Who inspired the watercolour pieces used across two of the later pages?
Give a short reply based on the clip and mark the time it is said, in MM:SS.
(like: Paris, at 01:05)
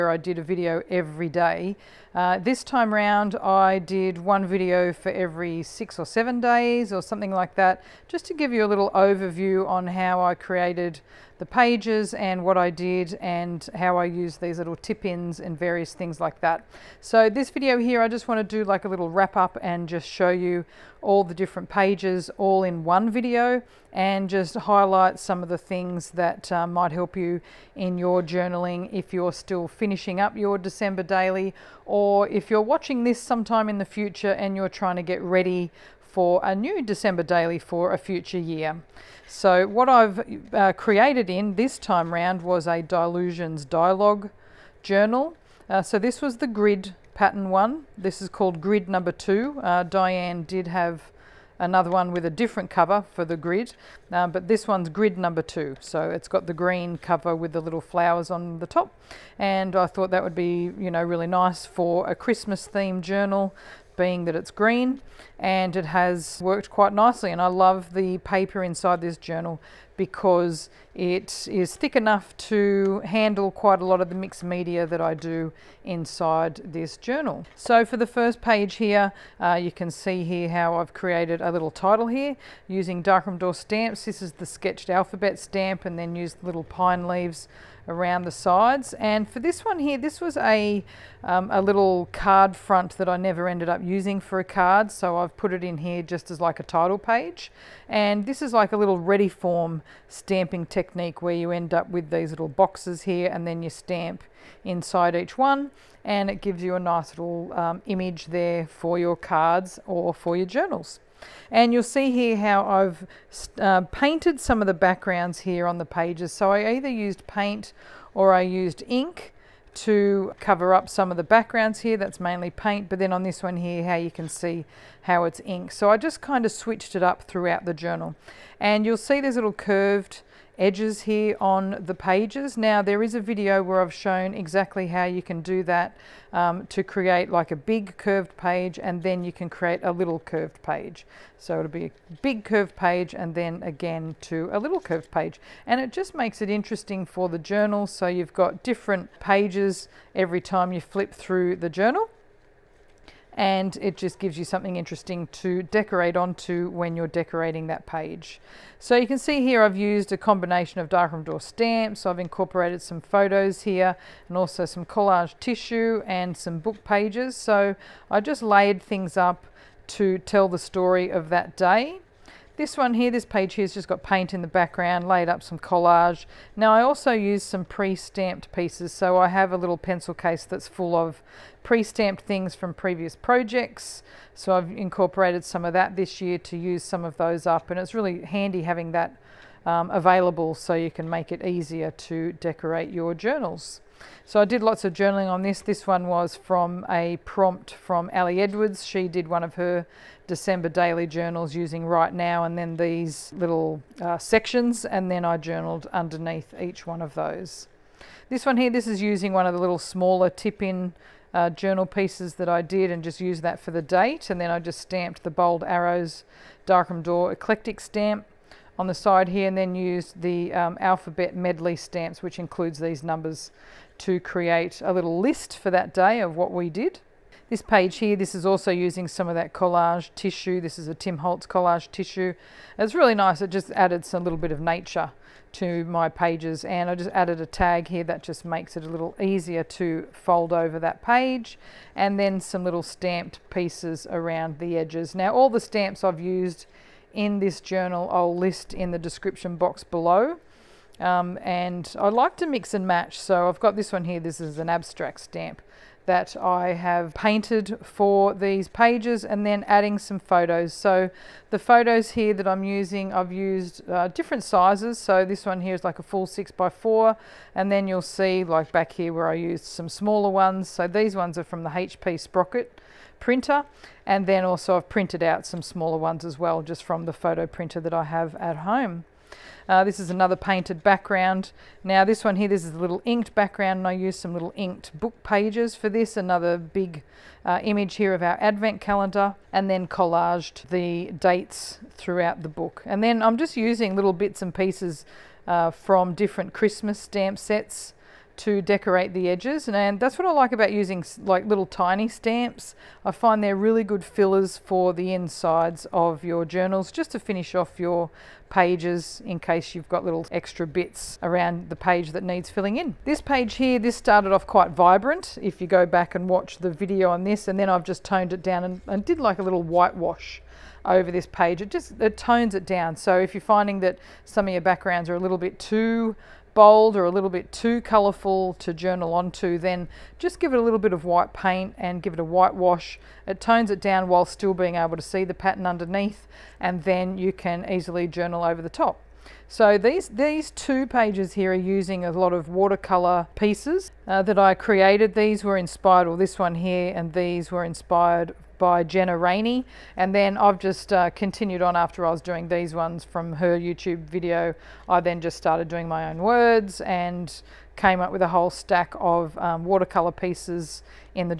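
Jenna Rainey, at 05:48.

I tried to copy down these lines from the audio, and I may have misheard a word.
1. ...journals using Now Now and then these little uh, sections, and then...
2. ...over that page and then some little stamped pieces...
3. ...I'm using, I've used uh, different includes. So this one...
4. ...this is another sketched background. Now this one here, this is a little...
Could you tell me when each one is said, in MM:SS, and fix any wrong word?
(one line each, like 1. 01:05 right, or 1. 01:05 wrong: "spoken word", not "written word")
1. 03:21 wrong: "Right", not "Now"
2. 04:00 right
3. 04:22 wrong: "sizes", not "includes"
4. 04:39 wrong: "painted", not "sketched".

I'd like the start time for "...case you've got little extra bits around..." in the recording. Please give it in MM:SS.
05:09.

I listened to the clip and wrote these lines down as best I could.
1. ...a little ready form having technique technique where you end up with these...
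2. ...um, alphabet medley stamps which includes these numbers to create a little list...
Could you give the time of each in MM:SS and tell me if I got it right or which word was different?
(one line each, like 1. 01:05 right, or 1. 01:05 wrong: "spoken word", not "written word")
1. 01:38 wrong: "stamping", not "having"
2. 03:40 right.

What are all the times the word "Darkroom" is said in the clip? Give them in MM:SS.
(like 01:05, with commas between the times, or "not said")
01:23, 02:40, 03:36.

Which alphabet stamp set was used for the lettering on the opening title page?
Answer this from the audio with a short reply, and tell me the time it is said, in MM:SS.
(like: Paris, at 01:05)
Sketched alphabet, at 01:24.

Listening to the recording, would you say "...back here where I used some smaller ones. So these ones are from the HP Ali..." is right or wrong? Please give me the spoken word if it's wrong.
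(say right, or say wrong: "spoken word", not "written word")
wrong: "Sprocket", not "Ali".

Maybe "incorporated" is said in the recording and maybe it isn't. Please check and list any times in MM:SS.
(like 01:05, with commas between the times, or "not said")
02:42, 03:04.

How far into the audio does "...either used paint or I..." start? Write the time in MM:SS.
01:56.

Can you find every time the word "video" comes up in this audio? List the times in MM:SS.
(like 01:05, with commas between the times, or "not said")
00:00, 00:04, 00:17, 00:23, 02:13, 05:16, 05:54.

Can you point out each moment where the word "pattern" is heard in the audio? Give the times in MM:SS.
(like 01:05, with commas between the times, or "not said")
00:47, 05:35.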